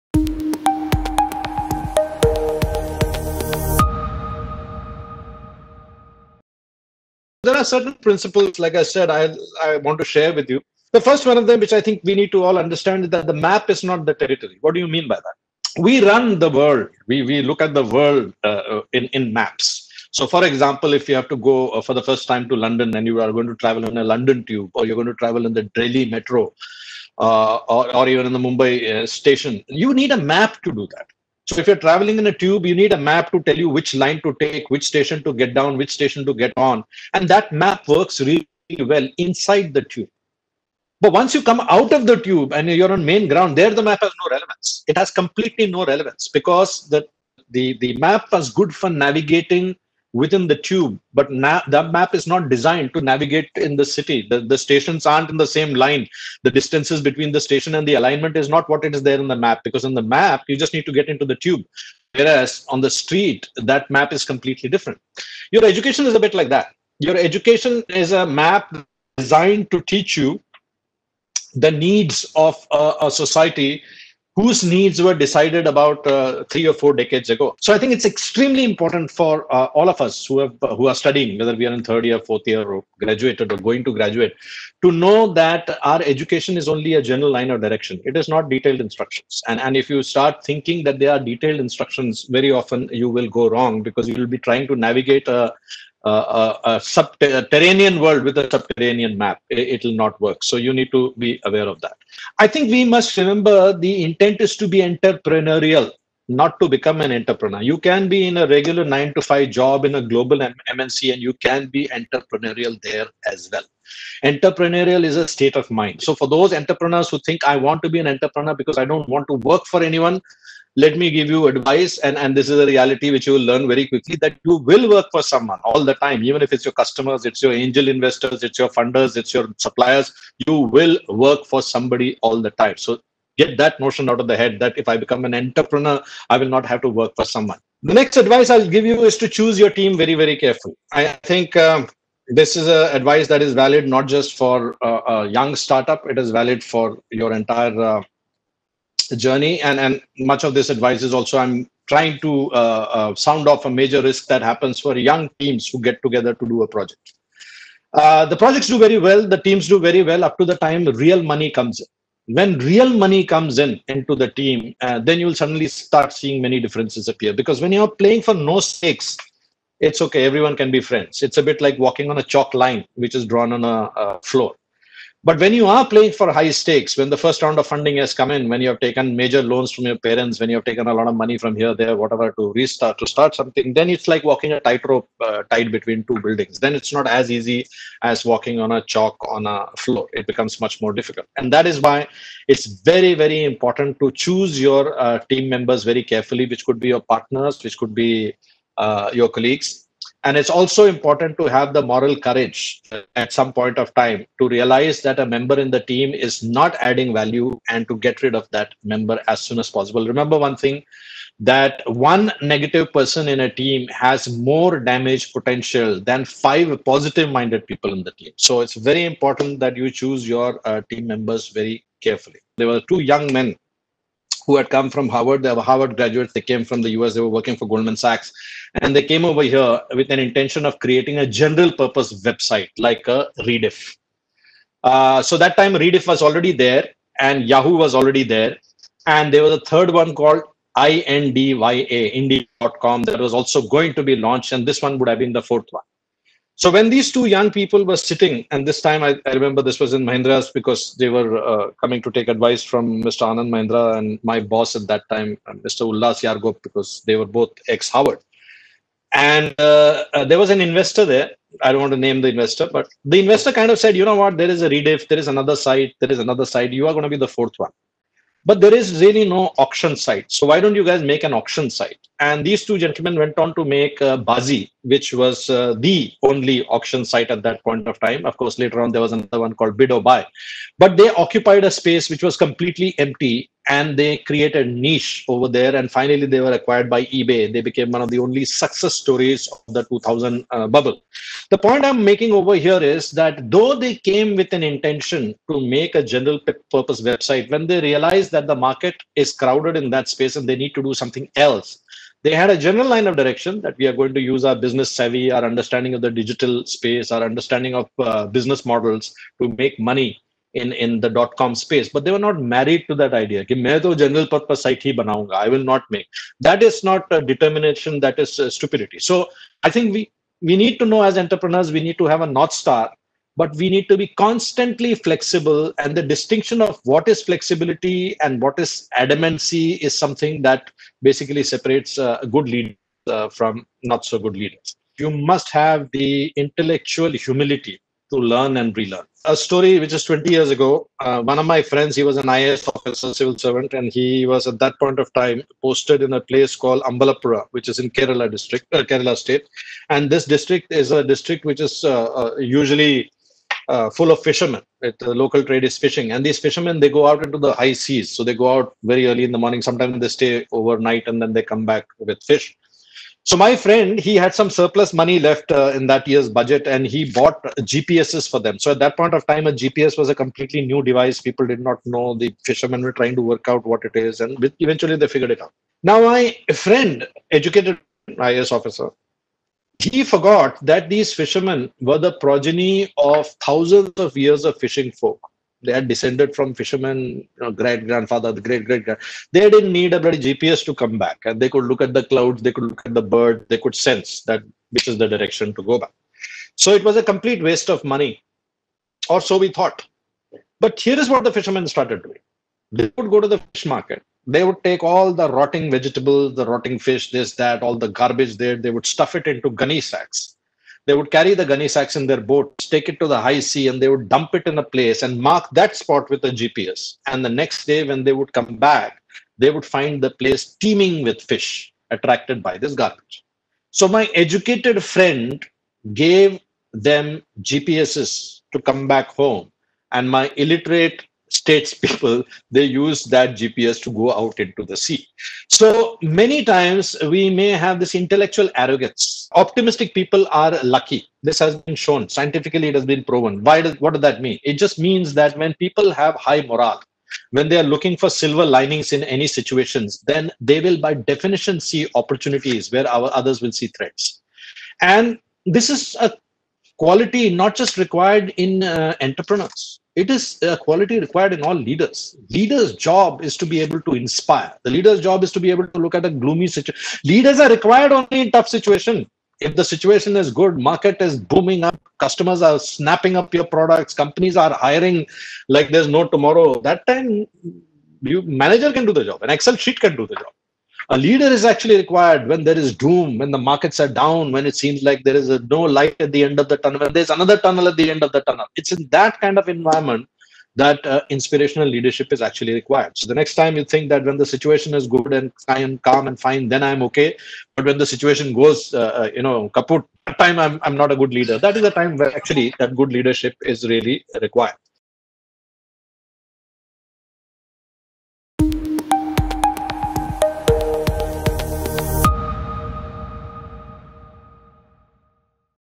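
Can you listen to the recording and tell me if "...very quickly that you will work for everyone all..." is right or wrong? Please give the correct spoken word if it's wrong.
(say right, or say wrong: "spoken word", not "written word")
wrong: "someone", not "everyone".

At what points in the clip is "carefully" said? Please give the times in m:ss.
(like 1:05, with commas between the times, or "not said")
2:20, 3:16, 3:42.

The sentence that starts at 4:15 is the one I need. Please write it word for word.
Ulhas Yargop, because they were both ex-Harvard.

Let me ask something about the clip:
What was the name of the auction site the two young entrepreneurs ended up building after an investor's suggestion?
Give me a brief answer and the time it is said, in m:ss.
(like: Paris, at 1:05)
Baazee, at 4:34.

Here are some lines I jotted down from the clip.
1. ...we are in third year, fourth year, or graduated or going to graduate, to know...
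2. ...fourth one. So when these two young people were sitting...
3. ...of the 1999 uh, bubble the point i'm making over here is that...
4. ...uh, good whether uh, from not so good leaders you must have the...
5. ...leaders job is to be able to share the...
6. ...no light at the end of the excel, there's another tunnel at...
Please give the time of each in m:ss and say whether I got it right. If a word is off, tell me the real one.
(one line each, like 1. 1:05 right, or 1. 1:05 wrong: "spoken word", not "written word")
1. 1:21 right
2. 4:05 right
3. 4:49 wrong: "2000", not "1999"
4. 5:32 wrong: "leader", not "whether"
5. 7:42 wrong: "inspire", not "share"
6. 8:05 wrong: "tunnel", not "excel".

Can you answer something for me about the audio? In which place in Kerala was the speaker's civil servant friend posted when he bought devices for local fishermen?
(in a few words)
Ambalappuzha.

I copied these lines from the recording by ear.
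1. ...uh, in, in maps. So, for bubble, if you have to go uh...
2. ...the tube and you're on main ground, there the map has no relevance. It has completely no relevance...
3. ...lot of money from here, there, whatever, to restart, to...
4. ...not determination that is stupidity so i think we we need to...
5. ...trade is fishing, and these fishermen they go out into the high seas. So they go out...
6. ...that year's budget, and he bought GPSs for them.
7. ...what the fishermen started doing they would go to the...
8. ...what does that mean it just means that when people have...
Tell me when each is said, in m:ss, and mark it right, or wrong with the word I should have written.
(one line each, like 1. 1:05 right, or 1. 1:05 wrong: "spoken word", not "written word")
1. 0:18 wrong: "example", not "bubble"
2. 0:42 right
3. 3:00 right
4. 5:16 right
5. 5:55 right
6. 6:05 right
7. 6:41 right
8. 7:23 right.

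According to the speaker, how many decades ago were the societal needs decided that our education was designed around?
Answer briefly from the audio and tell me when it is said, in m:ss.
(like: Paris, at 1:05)
3 or 4 decades, at 1:16.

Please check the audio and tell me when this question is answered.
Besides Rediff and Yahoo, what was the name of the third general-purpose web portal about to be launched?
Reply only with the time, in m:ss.
4:02.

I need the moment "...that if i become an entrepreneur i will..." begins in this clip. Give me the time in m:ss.
2:14.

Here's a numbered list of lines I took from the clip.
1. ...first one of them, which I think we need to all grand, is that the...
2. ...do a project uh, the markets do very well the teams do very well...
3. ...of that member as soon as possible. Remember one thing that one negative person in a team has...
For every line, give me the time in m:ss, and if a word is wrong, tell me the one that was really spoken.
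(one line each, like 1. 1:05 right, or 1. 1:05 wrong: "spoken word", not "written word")
1. 0:11 wrong: "understand", not "grand"
2. 2:36 wrong: "projects", not "markets"
3. 3:28 right.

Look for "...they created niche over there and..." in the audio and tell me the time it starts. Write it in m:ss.
4:43.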